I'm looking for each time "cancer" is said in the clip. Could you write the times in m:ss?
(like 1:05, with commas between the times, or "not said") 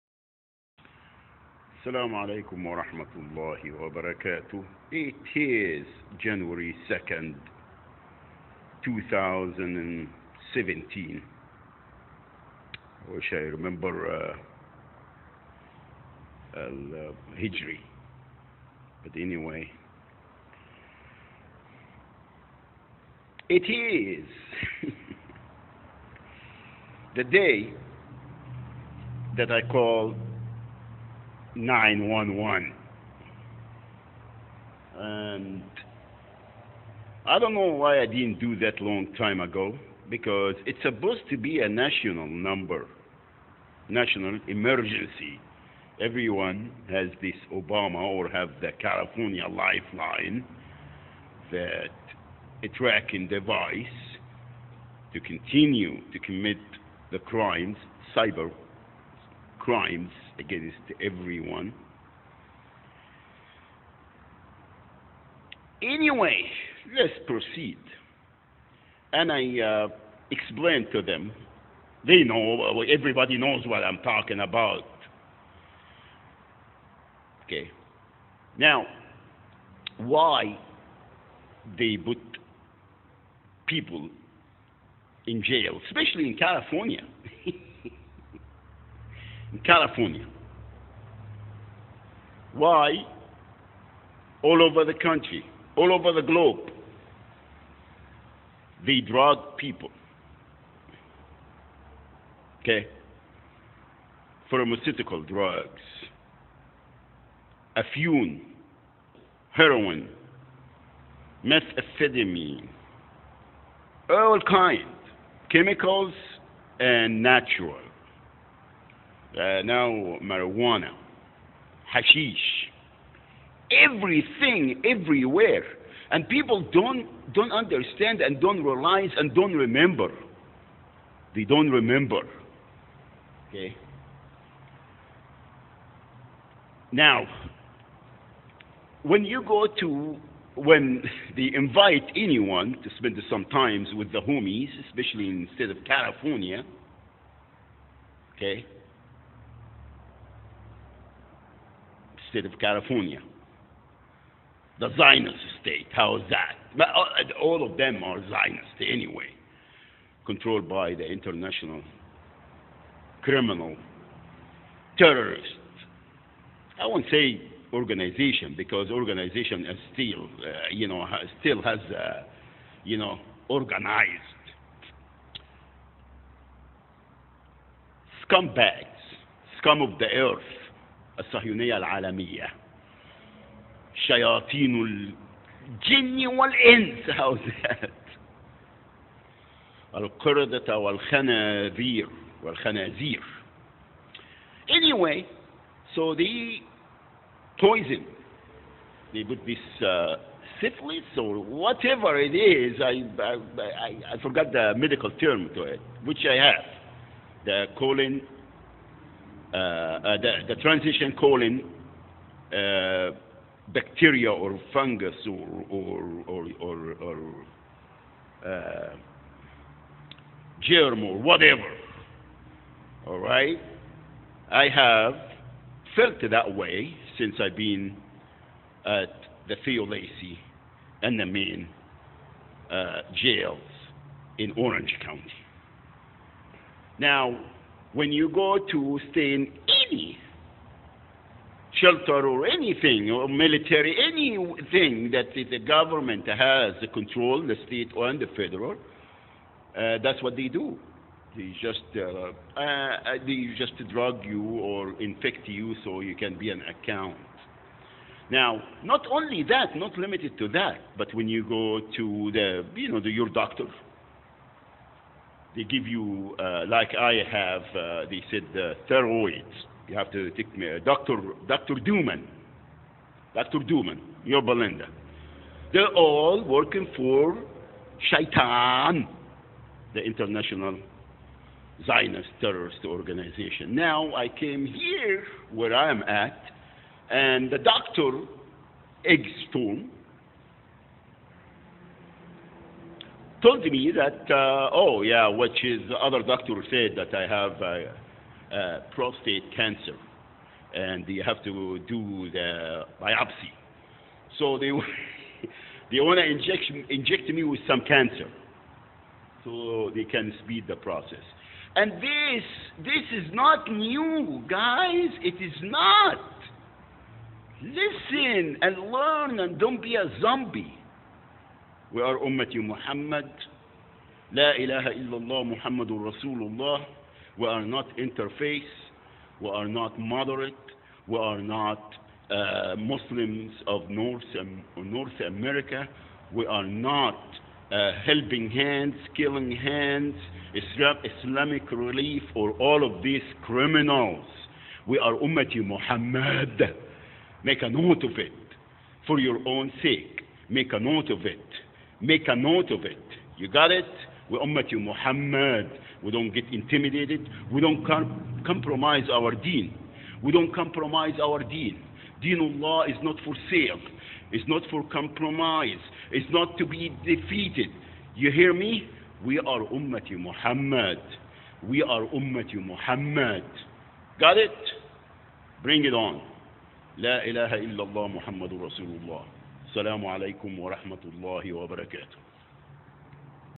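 4:59, 5:07.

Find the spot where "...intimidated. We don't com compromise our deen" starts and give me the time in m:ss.
5:56.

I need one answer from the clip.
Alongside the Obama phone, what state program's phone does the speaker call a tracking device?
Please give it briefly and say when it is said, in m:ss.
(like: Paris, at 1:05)
California lifeline, at 0:48.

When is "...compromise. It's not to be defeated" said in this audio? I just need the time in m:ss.
6:04.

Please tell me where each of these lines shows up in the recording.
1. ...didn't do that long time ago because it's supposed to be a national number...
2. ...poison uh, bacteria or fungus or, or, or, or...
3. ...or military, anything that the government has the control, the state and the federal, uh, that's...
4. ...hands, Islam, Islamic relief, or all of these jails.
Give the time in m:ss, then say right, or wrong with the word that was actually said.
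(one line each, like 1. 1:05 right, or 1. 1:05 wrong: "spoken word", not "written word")
1. 0:38 right
2. 3:31 wrong: "colon", not "poison"
3. 4:03 right
4. 5:39 wrong: "criminals", not "jails".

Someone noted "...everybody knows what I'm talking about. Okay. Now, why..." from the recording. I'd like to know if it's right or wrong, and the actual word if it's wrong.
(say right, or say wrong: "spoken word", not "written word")
right.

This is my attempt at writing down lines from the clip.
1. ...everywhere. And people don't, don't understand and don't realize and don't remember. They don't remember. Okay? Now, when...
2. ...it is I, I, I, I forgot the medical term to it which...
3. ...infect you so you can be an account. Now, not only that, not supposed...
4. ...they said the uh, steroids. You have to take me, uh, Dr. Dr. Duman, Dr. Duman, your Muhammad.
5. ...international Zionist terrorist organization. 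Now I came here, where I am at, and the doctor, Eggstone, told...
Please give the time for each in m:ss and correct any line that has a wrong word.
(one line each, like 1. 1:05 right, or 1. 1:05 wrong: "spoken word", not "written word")
1. 2:04 right
2. 3:22 right
3. 4:15 wrong: "limited", not "supposed"
4. 4:28 wrong: "Belinda", not "Muhammad"
5. 4:40 right.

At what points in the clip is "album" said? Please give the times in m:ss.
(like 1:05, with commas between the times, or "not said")
not said.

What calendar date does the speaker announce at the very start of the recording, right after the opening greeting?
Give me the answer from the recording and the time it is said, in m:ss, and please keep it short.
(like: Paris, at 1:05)
January 2nd, 2017, at 0:06.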